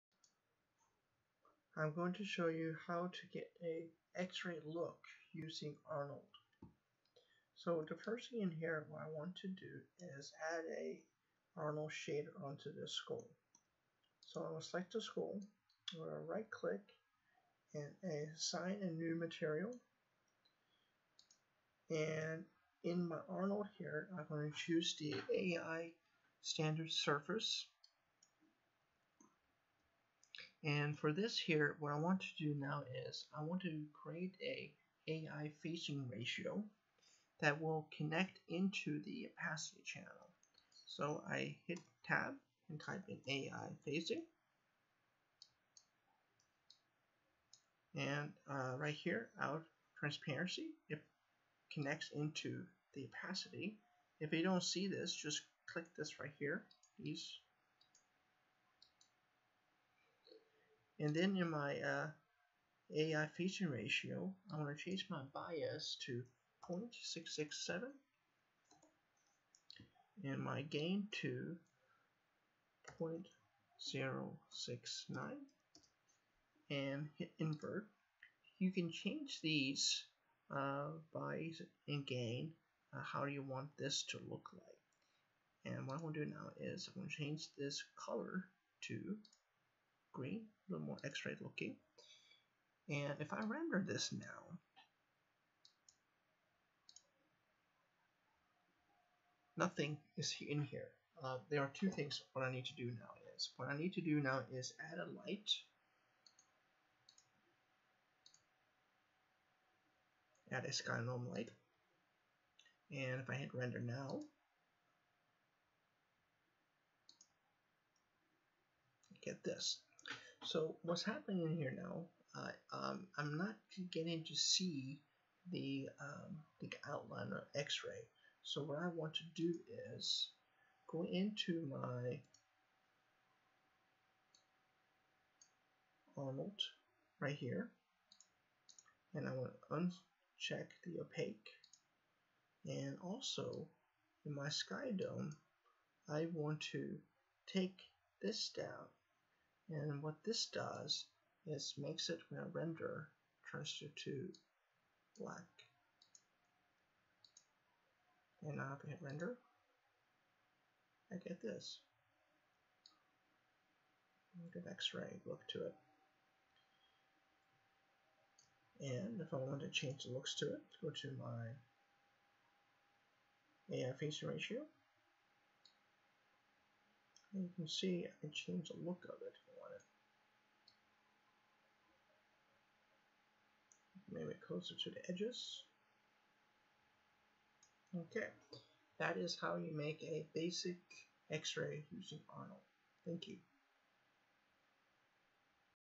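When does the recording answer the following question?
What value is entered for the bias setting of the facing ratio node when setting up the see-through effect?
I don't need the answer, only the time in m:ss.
1:06.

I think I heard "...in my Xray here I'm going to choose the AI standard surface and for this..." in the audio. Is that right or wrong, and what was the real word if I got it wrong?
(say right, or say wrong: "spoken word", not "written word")
wrong: "Arnold", not "Xray".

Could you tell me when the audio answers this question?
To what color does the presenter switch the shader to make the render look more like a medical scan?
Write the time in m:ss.
1:30.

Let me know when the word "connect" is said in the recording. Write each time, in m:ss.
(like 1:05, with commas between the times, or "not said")
0:37, 0:51.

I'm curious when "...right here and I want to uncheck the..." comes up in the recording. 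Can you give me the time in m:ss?
2:17.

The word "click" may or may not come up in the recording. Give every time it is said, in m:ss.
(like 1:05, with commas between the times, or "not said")
0:16, 0:55.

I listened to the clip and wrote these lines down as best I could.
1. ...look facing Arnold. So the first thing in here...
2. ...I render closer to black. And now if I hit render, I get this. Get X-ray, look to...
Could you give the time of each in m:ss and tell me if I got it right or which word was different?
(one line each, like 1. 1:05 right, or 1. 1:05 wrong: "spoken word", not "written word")
1. 0:04 wrong: "using", not "facing"
2. 2:32 wrong: "transfer", not "closer".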